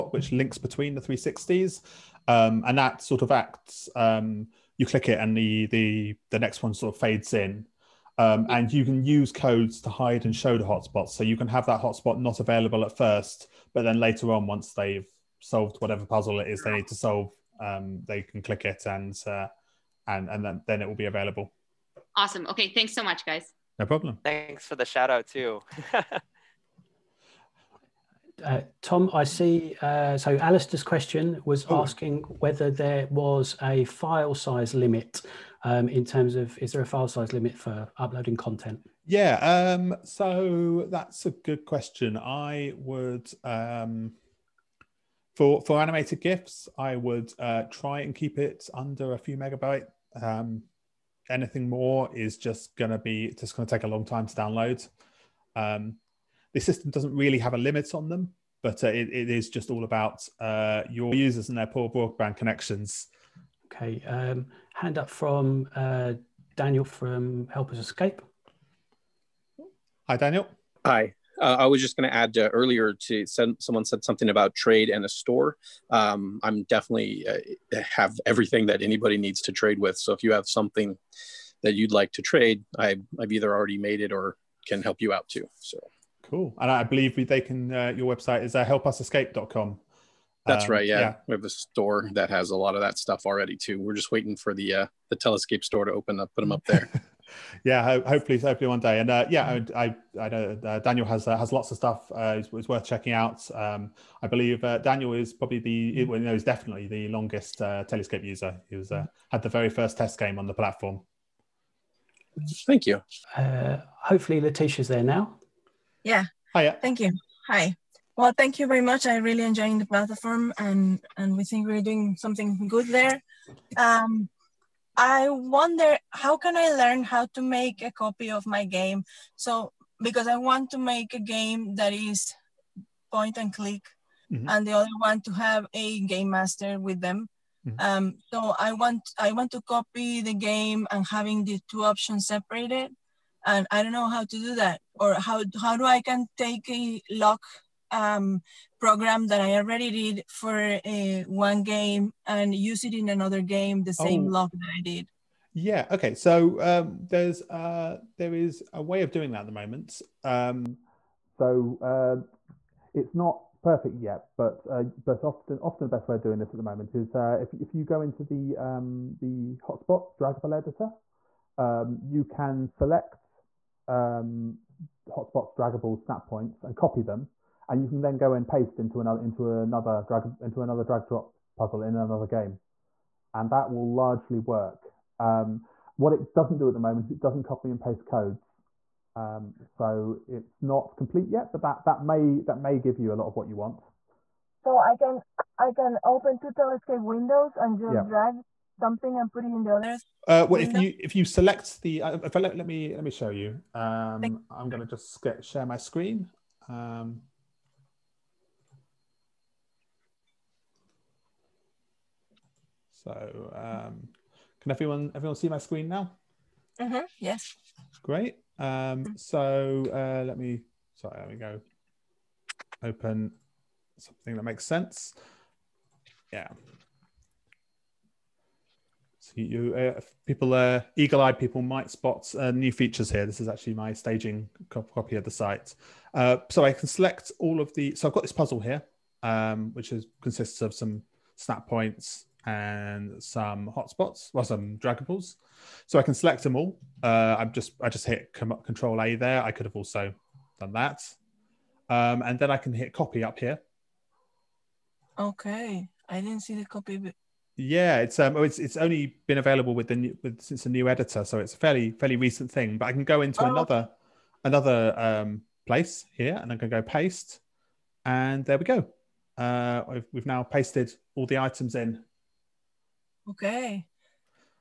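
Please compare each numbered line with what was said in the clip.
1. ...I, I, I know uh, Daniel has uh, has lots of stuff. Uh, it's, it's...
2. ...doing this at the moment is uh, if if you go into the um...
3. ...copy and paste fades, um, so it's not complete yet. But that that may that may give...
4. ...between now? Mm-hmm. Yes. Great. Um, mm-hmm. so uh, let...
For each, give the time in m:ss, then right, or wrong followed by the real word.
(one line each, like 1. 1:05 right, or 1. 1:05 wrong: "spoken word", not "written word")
1. 1:39 right
2. 2:46 right
3. 3:07 wrong: "codes", not "fades"
4. 3:35 wrong: "screen", not "between".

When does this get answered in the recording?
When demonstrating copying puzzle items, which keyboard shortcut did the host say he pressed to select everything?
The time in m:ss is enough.
4:08.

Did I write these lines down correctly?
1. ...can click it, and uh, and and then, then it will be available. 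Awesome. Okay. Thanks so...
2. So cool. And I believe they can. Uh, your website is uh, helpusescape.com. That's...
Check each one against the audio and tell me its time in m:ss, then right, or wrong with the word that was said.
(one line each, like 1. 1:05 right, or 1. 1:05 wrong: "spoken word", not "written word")
1. 0:18 right
2. 1:25 right.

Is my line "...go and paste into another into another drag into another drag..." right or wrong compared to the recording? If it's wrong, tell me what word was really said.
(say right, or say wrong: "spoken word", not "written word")
right.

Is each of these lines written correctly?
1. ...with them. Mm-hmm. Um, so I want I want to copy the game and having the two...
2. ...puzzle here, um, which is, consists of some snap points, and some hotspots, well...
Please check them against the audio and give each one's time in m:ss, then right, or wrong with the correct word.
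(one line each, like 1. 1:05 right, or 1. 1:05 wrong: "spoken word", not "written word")
1. 2:16 right
2. 3:58 right.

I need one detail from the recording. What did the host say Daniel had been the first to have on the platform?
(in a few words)
test game.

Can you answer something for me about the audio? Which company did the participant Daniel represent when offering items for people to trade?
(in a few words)
Help Us Escape.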